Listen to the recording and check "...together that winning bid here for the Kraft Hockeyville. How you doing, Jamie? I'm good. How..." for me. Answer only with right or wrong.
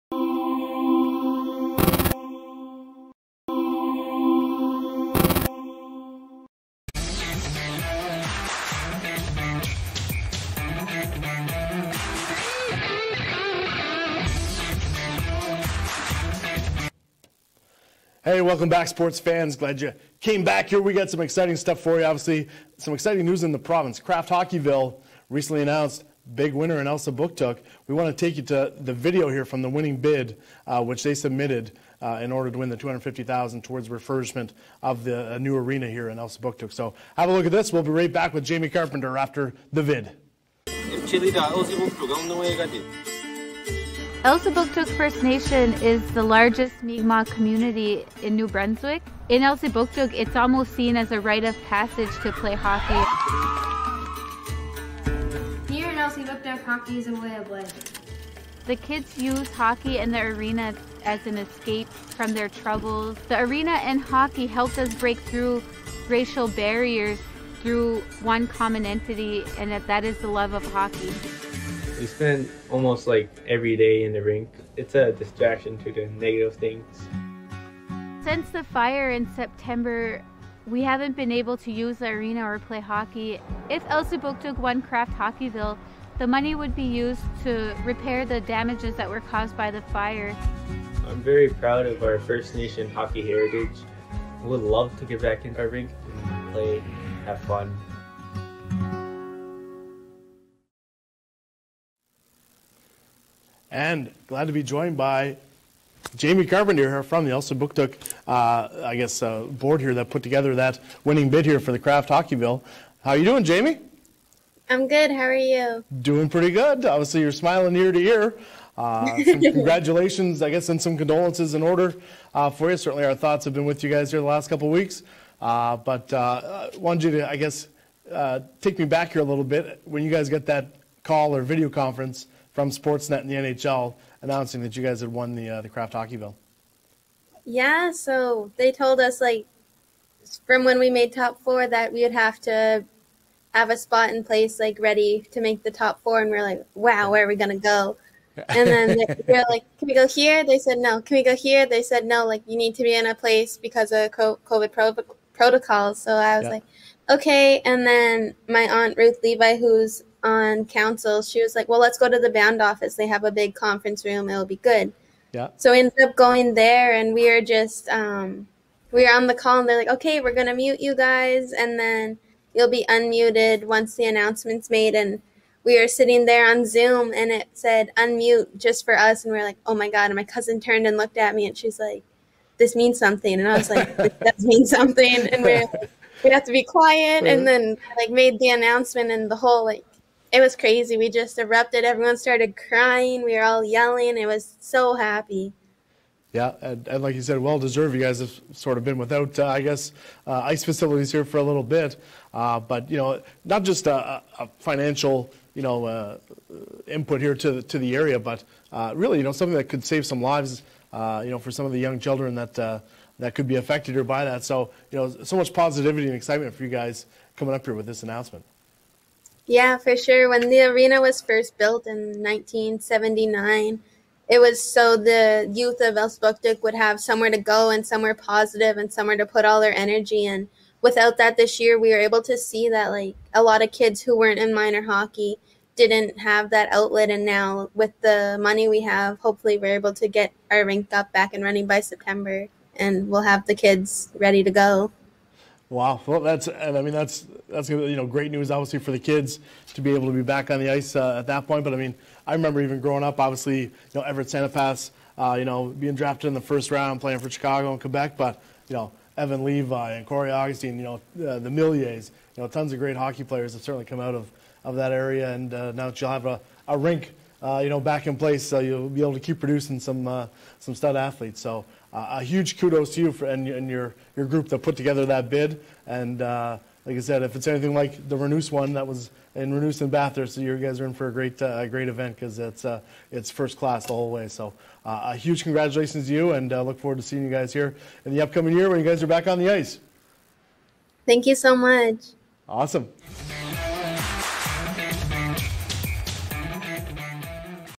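right.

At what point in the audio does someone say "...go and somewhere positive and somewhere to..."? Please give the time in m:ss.
3:47.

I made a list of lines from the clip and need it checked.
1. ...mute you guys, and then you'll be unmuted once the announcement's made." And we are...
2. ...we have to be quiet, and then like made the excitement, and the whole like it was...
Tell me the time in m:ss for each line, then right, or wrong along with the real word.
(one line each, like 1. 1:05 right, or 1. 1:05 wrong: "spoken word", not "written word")
1. 2:50 right
2. 3:06 wrong: "announcement", not "excitement".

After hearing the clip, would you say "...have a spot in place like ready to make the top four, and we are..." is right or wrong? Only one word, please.
right.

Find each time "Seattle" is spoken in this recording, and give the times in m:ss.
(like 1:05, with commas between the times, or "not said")
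not said.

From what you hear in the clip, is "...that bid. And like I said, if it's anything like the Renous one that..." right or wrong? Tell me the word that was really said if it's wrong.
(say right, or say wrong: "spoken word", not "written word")
right.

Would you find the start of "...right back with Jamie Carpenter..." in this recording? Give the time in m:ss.
0:37.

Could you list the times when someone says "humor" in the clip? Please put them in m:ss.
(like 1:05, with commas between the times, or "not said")
not said.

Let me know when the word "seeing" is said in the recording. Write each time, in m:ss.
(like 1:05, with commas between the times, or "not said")
4:47.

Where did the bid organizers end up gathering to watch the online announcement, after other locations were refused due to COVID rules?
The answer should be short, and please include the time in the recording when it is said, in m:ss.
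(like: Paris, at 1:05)
The band office, at 2:42.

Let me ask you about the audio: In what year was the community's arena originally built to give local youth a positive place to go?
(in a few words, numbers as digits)
1979.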